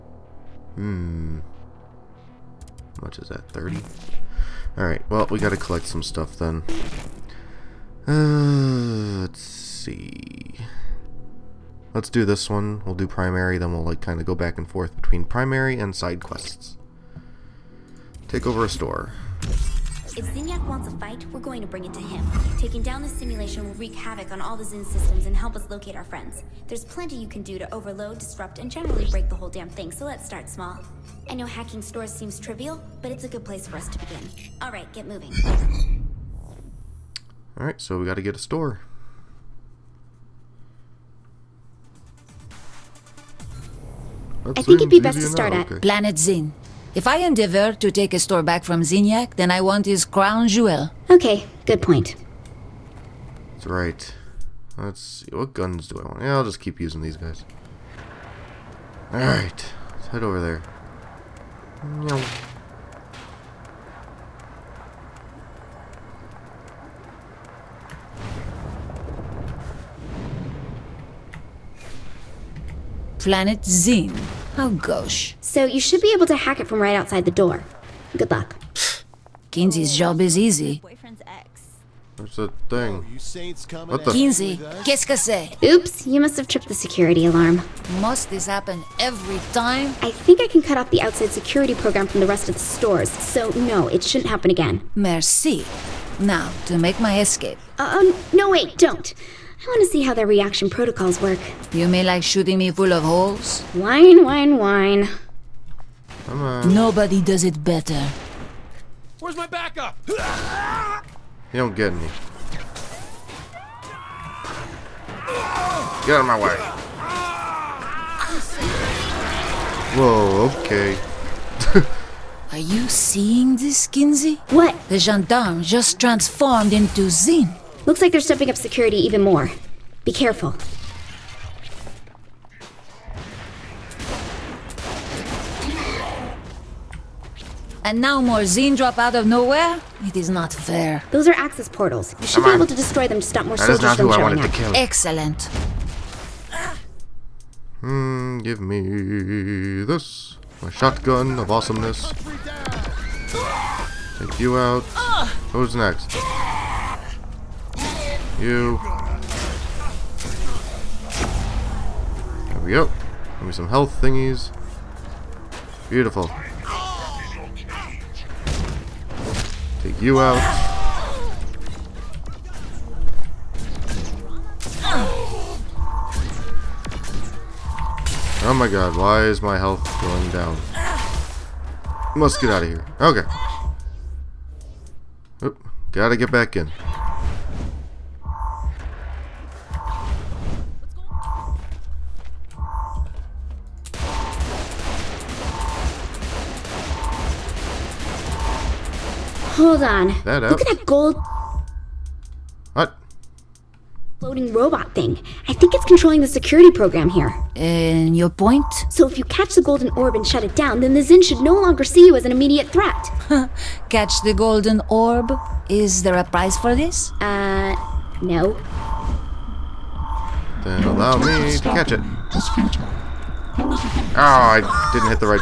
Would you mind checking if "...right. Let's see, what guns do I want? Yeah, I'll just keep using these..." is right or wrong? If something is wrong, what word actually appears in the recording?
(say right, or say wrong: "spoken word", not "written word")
right.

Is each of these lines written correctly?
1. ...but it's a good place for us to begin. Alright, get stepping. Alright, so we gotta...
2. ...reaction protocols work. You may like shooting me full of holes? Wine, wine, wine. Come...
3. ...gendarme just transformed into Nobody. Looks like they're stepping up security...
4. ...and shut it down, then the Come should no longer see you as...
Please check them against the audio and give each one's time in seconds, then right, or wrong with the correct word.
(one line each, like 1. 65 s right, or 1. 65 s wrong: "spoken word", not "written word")
1. 33 s wrong: "moving", not "stepping"
2. 100 s right
3. 124 s wrong: "Zin", not "Nobody"
4. 210 s wrong: "Zin", not "Come".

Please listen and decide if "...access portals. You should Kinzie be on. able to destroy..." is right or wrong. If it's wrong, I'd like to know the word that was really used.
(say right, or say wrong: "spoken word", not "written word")
wrong: "Come", not "Kinzie".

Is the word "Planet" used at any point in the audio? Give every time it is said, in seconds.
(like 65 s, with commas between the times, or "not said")
45 s, 73 s.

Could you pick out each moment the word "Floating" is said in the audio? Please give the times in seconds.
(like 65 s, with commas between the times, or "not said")
204 s.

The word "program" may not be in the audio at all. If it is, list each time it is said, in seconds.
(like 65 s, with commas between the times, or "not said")
91 s, 206 s.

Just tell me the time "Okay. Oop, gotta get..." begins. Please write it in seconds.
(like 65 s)
183 s.